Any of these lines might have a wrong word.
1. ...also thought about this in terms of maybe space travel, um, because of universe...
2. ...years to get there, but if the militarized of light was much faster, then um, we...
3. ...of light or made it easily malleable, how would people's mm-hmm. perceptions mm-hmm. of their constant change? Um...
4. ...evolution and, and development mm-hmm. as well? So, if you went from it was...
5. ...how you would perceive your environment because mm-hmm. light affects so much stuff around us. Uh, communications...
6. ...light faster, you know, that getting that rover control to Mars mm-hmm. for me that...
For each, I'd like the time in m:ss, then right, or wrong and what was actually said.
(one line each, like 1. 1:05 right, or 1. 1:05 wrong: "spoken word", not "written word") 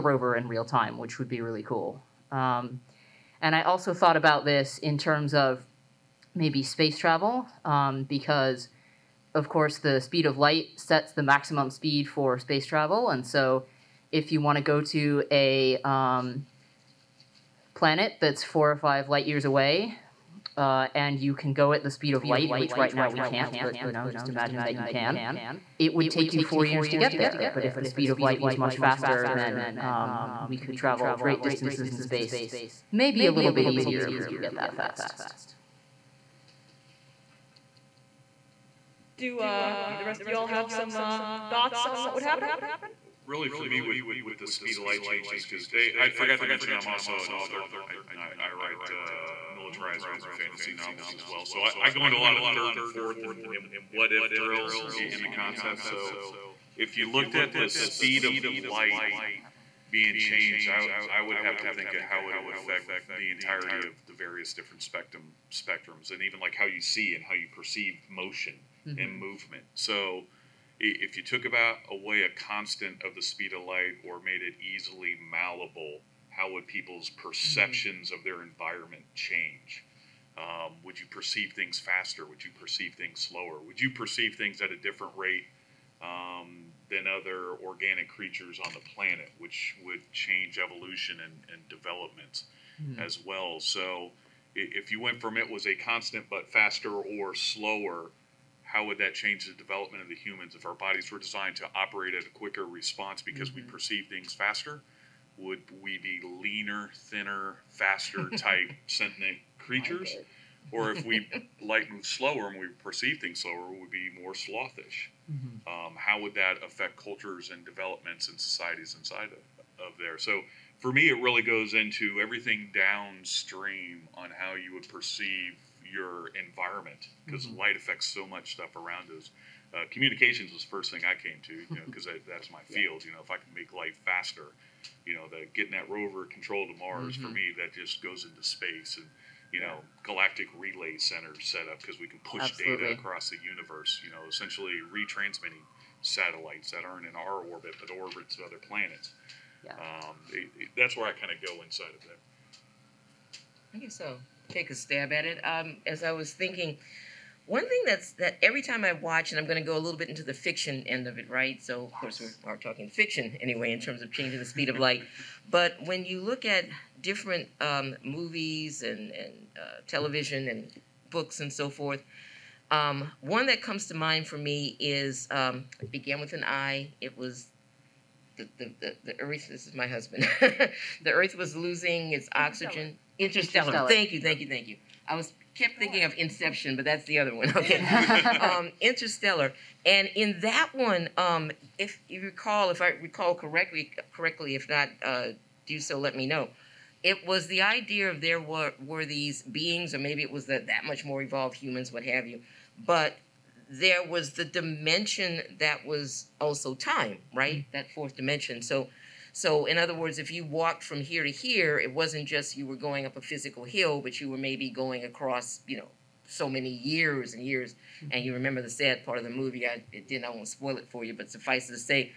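1. 0:03 wrong: "course", not "universe"
2. 0:26 wrong: "speed", not "militarized"
3. 1:13 wrong: "environment", not "constant"
4. 1:30 right
5. 2:04 right
6. 2:13 right.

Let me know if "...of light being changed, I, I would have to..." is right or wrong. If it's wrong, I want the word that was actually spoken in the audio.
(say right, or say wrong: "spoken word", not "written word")
right.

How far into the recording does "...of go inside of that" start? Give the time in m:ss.
2:31.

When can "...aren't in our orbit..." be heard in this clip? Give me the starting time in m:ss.
2:26.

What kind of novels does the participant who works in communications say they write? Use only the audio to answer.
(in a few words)
militarized urban fantasy.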